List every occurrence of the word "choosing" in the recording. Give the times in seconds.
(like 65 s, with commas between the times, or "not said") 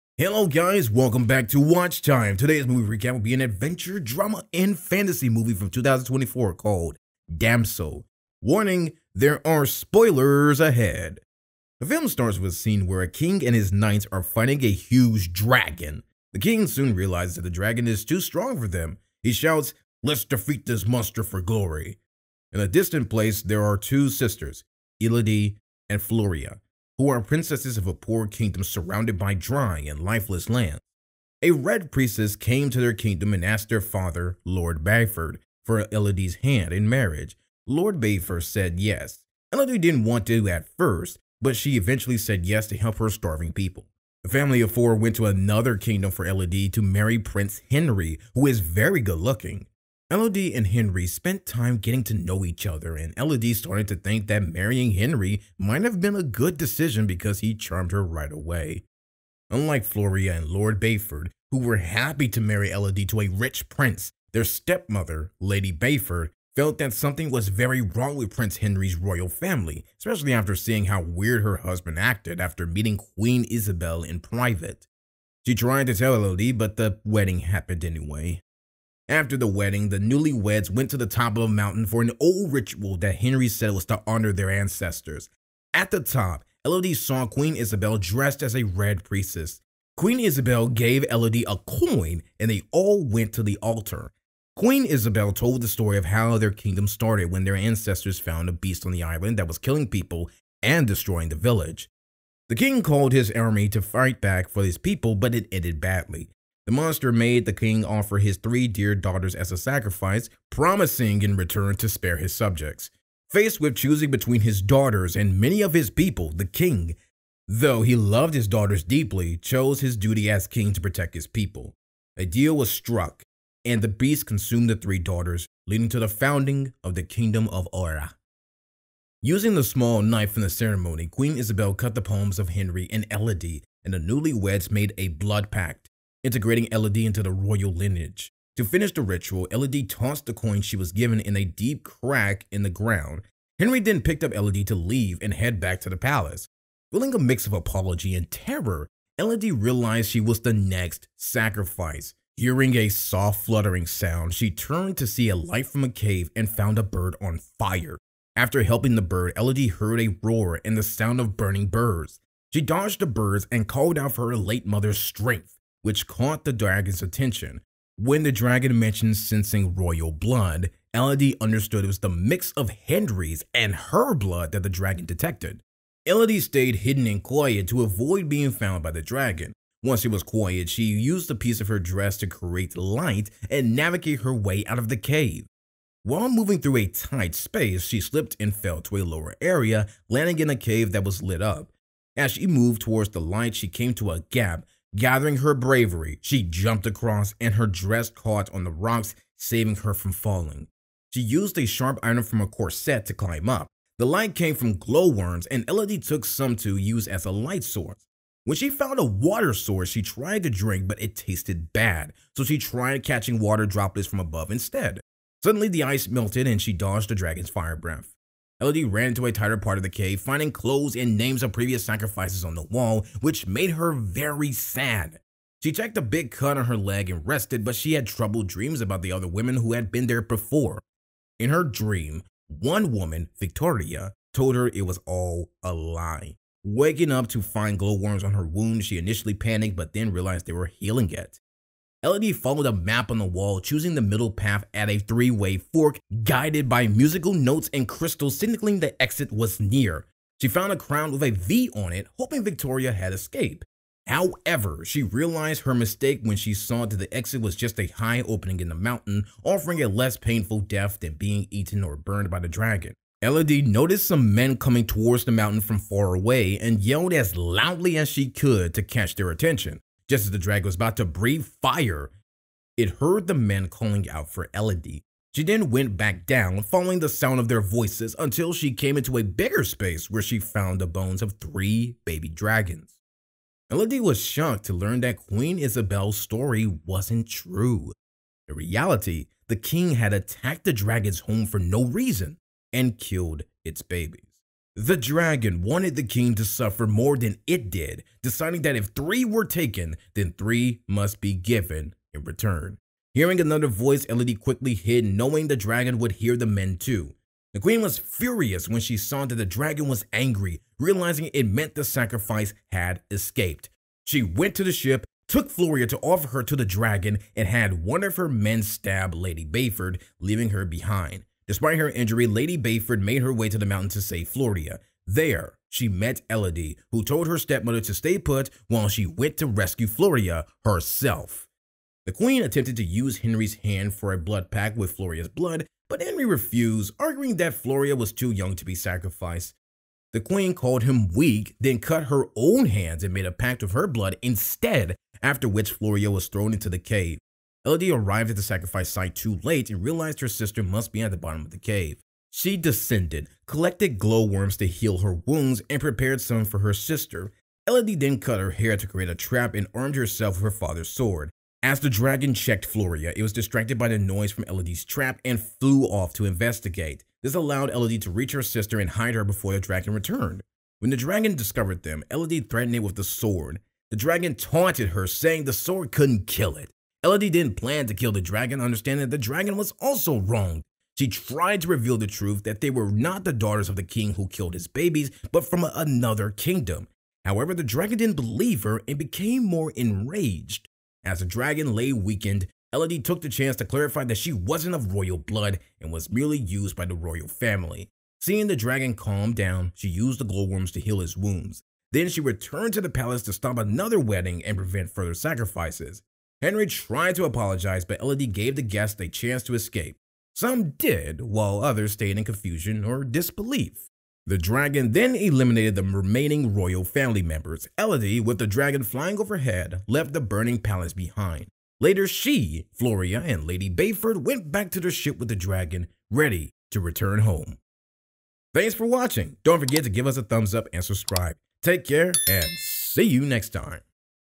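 113 s, 243 s.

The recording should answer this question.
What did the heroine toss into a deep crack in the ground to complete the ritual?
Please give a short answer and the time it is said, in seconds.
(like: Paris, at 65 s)
a coin, at 140 s.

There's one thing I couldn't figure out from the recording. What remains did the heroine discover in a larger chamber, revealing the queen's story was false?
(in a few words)
bones of three baby dragons.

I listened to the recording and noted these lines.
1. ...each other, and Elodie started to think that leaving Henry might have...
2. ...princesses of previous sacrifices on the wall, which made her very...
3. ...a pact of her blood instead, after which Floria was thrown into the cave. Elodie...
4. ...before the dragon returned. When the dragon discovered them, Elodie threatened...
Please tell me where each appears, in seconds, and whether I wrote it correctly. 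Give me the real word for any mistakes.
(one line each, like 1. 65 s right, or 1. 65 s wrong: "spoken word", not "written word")
1. 52 s wrong: "marrying", not "leaving"
2. 221 s wrong: "names", not "princesses"
3. 343 s right
4. 369 s right.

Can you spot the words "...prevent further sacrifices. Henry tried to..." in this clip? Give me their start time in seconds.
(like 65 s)
404 s.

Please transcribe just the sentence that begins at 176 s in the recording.
Elodie stayed hidden and quiet to avoid being found by the dragon.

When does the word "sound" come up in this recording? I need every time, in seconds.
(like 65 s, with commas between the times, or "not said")
153 s, 160 s, 277 s.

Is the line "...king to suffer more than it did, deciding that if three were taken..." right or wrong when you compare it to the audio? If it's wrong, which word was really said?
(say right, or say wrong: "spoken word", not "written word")
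right.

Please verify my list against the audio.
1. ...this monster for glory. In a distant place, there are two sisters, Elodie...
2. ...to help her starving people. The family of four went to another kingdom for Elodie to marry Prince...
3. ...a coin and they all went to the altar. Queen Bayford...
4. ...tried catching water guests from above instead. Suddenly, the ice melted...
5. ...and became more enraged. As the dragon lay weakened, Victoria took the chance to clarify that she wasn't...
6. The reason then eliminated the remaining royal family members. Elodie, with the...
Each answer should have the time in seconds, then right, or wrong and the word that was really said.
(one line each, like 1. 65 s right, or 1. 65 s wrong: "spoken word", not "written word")
1. 20 s right
2. 42 s right
3. 91 s wrong: "Isabel", not "Bayford"
4. 212 s wrong: "droplets", not "guests"
5. 388 s wrong: "Elodie", not "Victoria"
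6. 414 s wrong: "dragon", not "reason".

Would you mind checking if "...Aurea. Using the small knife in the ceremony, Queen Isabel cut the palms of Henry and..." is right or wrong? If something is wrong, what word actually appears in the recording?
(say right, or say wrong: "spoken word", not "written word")
right.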